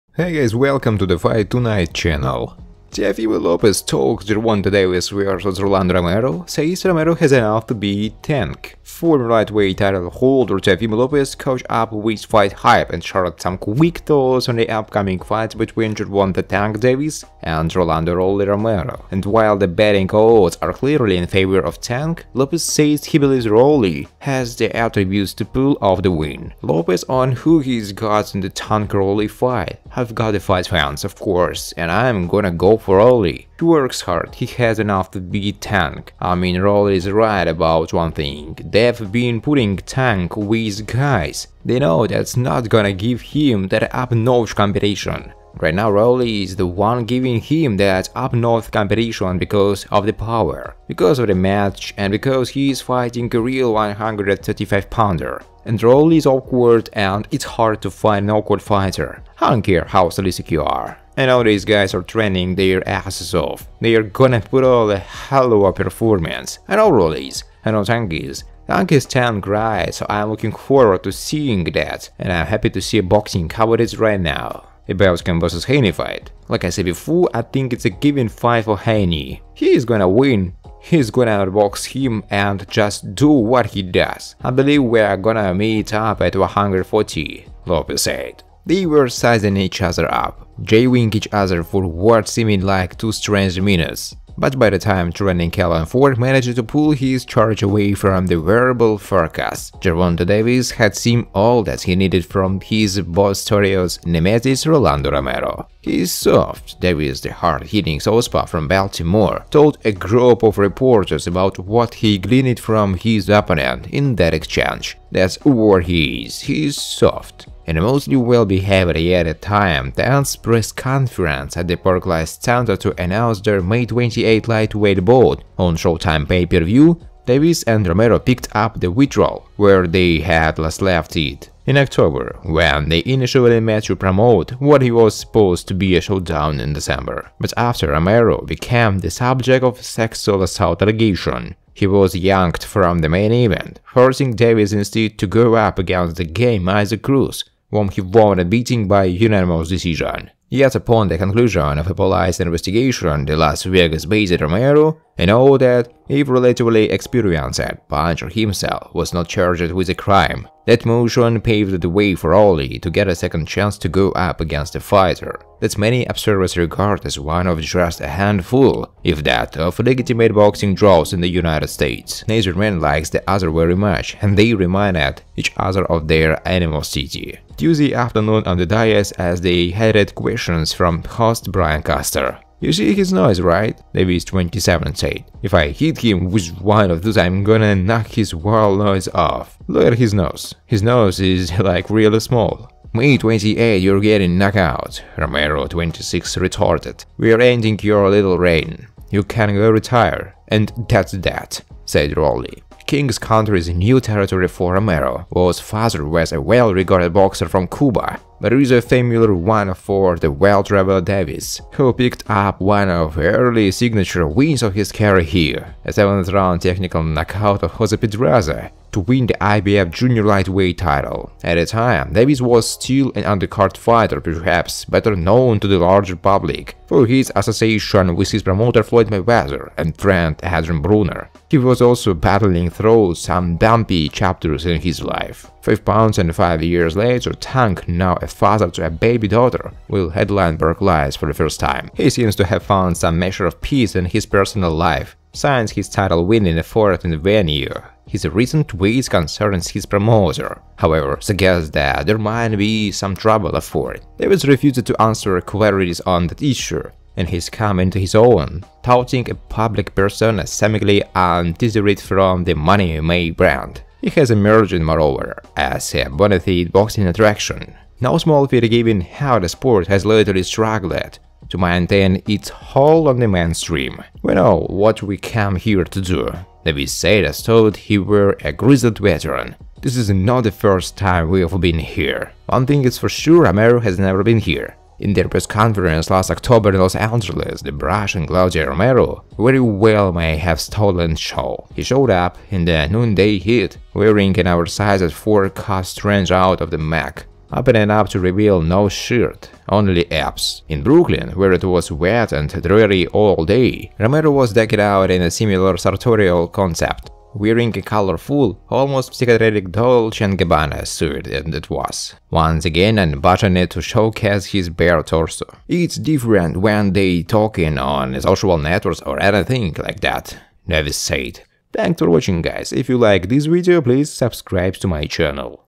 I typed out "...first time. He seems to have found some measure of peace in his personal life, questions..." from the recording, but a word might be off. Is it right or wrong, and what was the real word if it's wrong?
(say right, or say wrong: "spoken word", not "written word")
wrong: "signs", not "questions".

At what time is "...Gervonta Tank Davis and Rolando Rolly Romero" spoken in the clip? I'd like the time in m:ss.
0:15.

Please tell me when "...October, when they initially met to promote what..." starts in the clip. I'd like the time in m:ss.
2:11.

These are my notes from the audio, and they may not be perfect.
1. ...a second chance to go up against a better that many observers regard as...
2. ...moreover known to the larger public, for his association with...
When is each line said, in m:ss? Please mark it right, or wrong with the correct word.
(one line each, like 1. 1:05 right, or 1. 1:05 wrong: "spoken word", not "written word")
1. 2:43 wrong: "fighter", not "better"
2. 3:44 wrong: "better", not "moreover".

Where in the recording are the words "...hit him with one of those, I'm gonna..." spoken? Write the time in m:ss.
3:05.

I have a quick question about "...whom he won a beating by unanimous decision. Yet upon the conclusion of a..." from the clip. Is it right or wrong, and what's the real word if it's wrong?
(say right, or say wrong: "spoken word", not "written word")
right.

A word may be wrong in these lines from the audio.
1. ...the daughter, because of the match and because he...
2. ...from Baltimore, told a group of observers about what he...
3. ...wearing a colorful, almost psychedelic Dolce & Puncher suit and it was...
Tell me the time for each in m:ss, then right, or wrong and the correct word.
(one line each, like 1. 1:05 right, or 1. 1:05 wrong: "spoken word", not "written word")
1. 0:50 wrong: "power", not "daughter"
2. 1:48 wrong: "reporters", not "observers"
3. 5:07 wrong: "Gabbana", not "Puncher".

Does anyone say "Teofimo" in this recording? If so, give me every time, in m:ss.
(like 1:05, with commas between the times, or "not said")
0:02, 0:10.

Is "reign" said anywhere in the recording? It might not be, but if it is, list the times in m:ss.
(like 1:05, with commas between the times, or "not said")
3:18.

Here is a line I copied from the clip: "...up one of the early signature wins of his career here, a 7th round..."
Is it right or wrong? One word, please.
right.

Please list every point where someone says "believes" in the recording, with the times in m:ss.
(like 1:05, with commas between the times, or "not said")
0:23, 1:24.